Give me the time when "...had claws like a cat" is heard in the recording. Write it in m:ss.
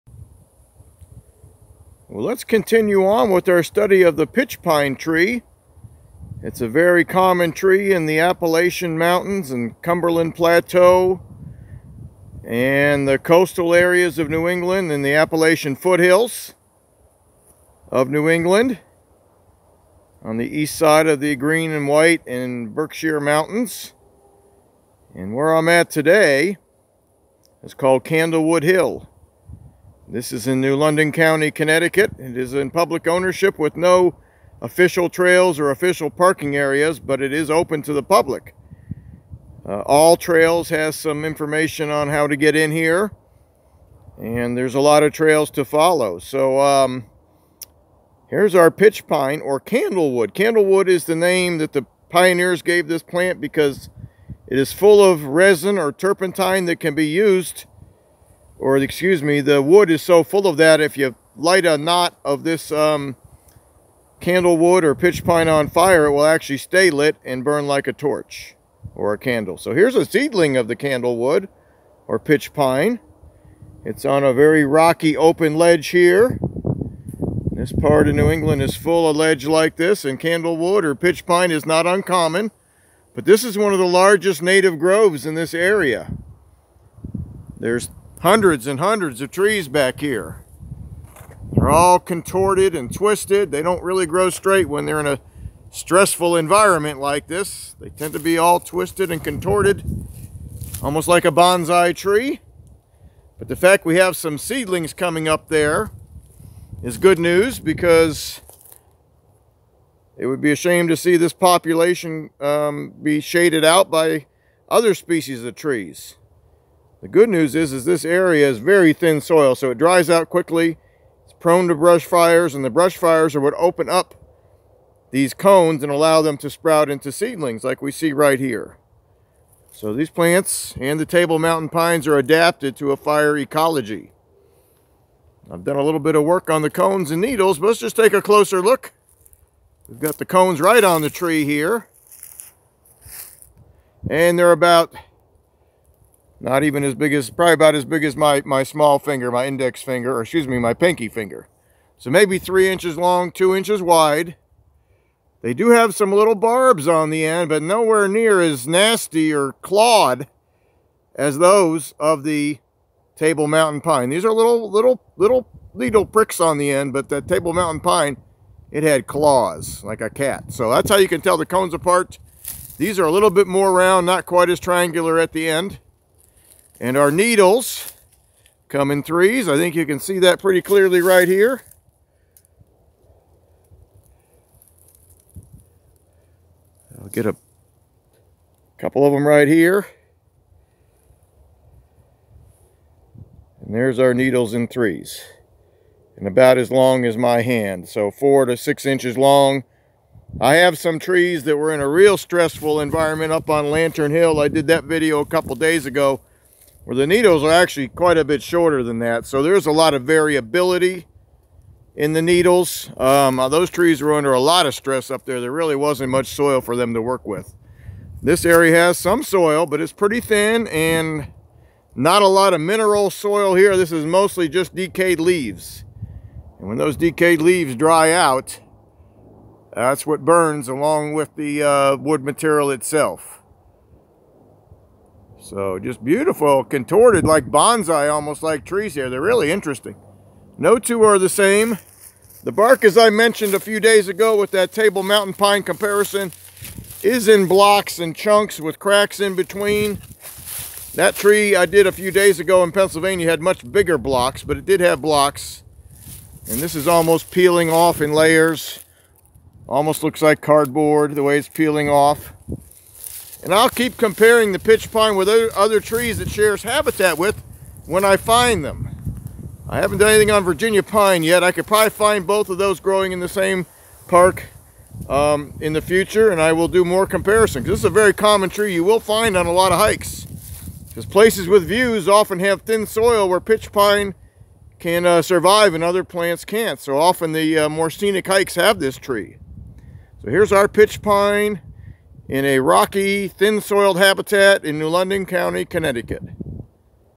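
2:48.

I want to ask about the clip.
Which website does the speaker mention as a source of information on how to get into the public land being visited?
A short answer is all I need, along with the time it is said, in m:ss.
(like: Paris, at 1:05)
All Trails, at 0:39.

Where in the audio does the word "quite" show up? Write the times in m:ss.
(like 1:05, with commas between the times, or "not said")
2:54, 3:27.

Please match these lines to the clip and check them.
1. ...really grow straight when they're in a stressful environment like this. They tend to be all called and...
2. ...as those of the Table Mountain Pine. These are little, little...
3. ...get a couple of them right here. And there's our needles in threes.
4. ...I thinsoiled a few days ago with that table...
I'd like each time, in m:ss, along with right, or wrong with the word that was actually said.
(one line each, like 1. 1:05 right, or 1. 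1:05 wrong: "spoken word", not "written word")
1. 1:33 wrong: "twisted", not "called"
2. 2:41 right
3. 3:07 right
4. 4:02 wrong: "mentioned", not "thinsoiled".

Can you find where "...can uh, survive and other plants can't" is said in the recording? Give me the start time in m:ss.
4:44.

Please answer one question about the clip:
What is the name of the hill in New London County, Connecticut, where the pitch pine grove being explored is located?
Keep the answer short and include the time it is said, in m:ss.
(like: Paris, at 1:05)
Candlewood Hill, at 0:28.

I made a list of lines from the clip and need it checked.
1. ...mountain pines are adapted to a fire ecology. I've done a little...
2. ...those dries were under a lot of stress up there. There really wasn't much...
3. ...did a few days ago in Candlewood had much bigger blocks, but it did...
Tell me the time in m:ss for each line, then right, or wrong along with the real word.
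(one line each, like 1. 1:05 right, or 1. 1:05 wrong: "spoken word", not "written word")
1. 2:11 right
2. 3:33 wrong: "trees", not "dries"
3. 4:11 wrong: "Pennsylvania", not "Candlewood".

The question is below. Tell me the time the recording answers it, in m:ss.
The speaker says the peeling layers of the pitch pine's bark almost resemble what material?
4:20.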